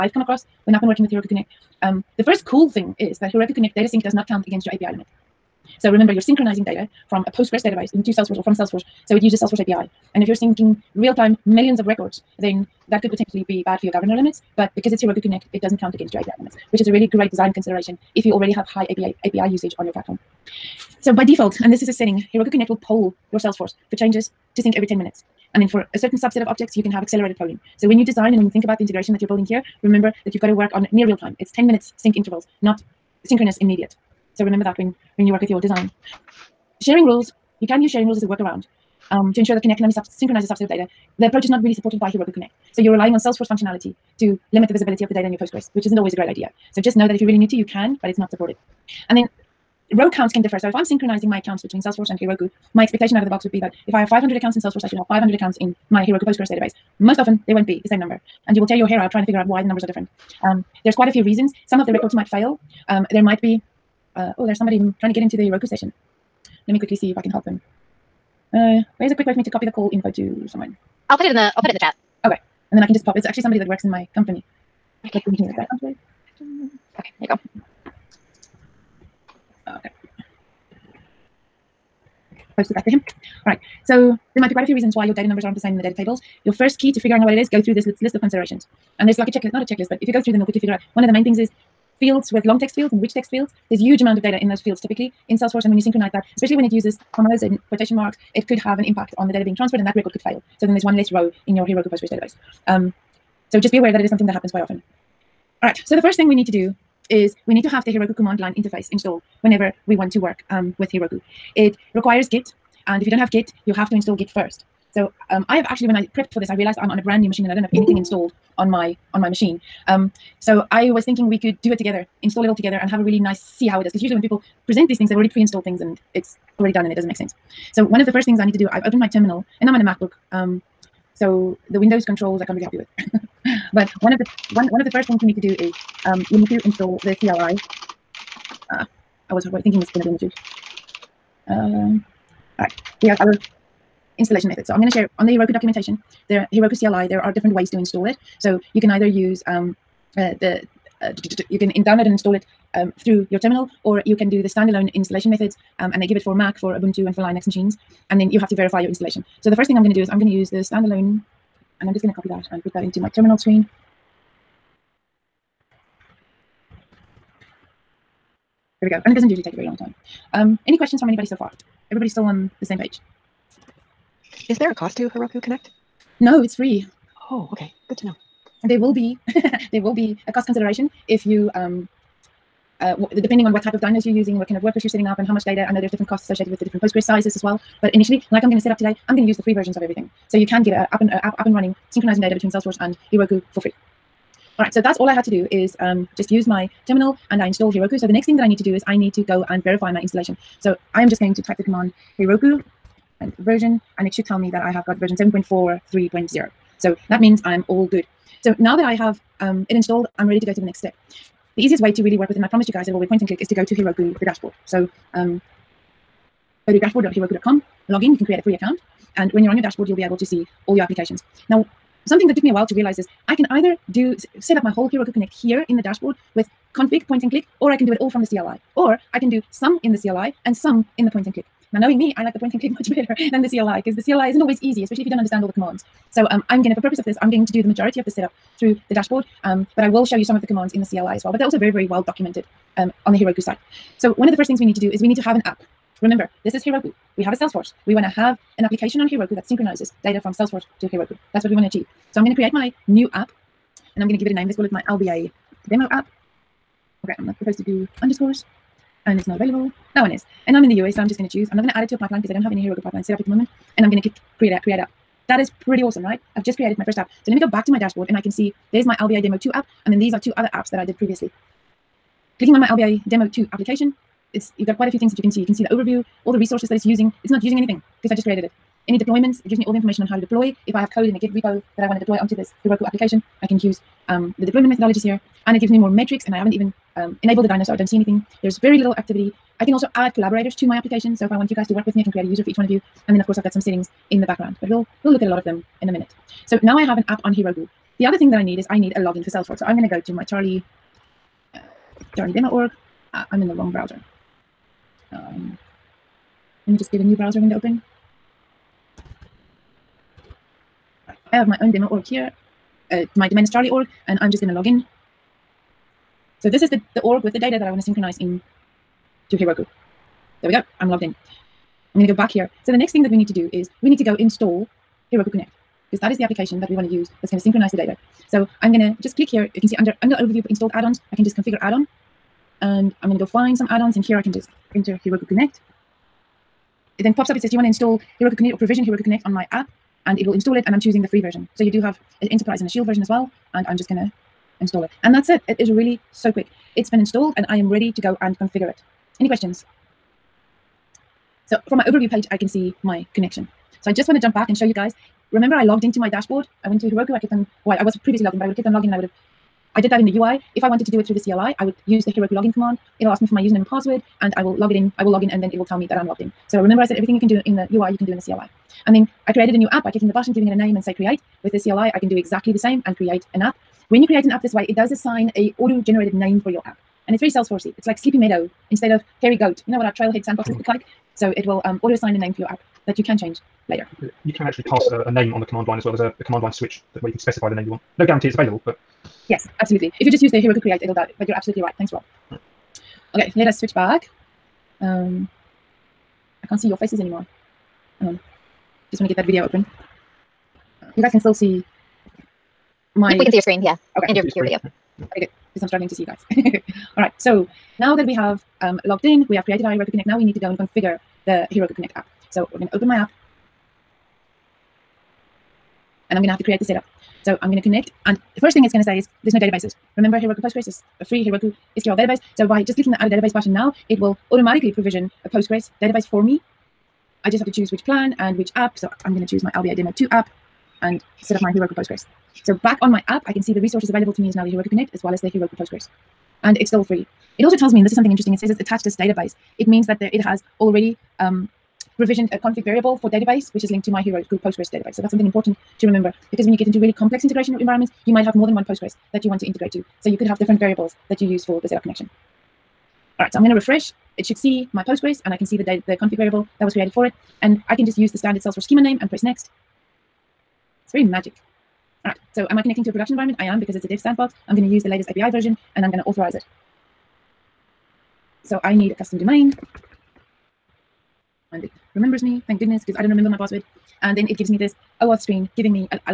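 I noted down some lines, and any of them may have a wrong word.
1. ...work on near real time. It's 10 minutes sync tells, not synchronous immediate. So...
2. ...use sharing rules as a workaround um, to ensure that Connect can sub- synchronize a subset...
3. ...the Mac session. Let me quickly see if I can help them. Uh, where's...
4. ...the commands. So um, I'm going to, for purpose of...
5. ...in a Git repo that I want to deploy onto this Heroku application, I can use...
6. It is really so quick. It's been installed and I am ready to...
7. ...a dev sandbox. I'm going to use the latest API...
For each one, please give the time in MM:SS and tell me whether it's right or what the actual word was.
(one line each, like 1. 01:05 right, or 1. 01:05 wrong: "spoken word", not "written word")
1. 00:30 wrong: "intervals", not "tells"
2. 00:37 right
3. 01:05 wrong: "Heroku", not "Mac"
4. 03:55 right
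5. 04:41 right
6. 05:45 right
7. 07:43 right.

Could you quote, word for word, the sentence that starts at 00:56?
Most often, they won't be the same number.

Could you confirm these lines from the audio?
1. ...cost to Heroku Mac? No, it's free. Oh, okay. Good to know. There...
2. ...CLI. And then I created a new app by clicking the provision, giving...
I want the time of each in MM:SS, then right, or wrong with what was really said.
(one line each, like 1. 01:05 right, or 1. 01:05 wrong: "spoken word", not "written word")
1. 02:54 wrong: "Connect", not "Mac"
2. 06:08 wrong: "button", not "provision".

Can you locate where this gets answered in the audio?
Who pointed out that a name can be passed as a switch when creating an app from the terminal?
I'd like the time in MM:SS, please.
06:31.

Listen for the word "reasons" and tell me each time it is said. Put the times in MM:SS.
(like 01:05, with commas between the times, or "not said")
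01:01, 01:24.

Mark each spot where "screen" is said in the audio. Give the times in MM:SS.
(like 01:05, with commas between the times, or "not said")
02:43, 06:43, 07:55.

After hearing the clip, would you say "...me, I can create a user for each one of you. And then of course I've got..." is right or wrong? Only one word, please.
right.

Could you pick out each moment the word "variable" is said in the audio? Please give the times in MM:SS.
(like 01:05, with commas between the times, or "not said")
07:22, 07:30, 07:36.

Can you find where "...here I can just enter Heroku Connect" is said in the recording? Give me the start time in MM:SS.
05:34.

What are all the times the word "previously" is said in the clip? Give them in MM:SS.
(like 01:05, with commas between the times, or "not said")
04:30, 05:58.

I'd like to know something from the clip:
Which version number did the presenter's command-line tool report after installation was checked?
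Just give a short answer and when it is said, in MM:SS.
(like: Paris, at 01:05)
7.43.0, at 03:25.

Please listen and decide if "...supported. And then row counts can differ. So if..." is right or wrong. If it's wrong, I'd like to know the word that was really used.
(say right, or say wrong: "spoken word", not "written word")
right.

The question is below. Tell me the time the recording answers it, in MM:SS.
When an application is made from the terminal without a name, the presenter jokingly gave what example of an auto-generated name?
06:17.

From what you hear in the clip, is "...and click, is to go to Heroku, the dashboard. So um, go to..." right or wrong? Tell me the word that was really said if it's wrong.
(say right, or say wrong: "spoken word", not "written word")
right.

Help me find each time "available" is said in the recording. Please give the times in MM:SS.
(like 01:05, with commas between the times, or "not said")
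04:19, 06:28, 07:13.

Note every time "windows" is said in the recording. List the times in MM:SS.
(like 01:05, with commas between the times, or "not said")
02:11, 05:07.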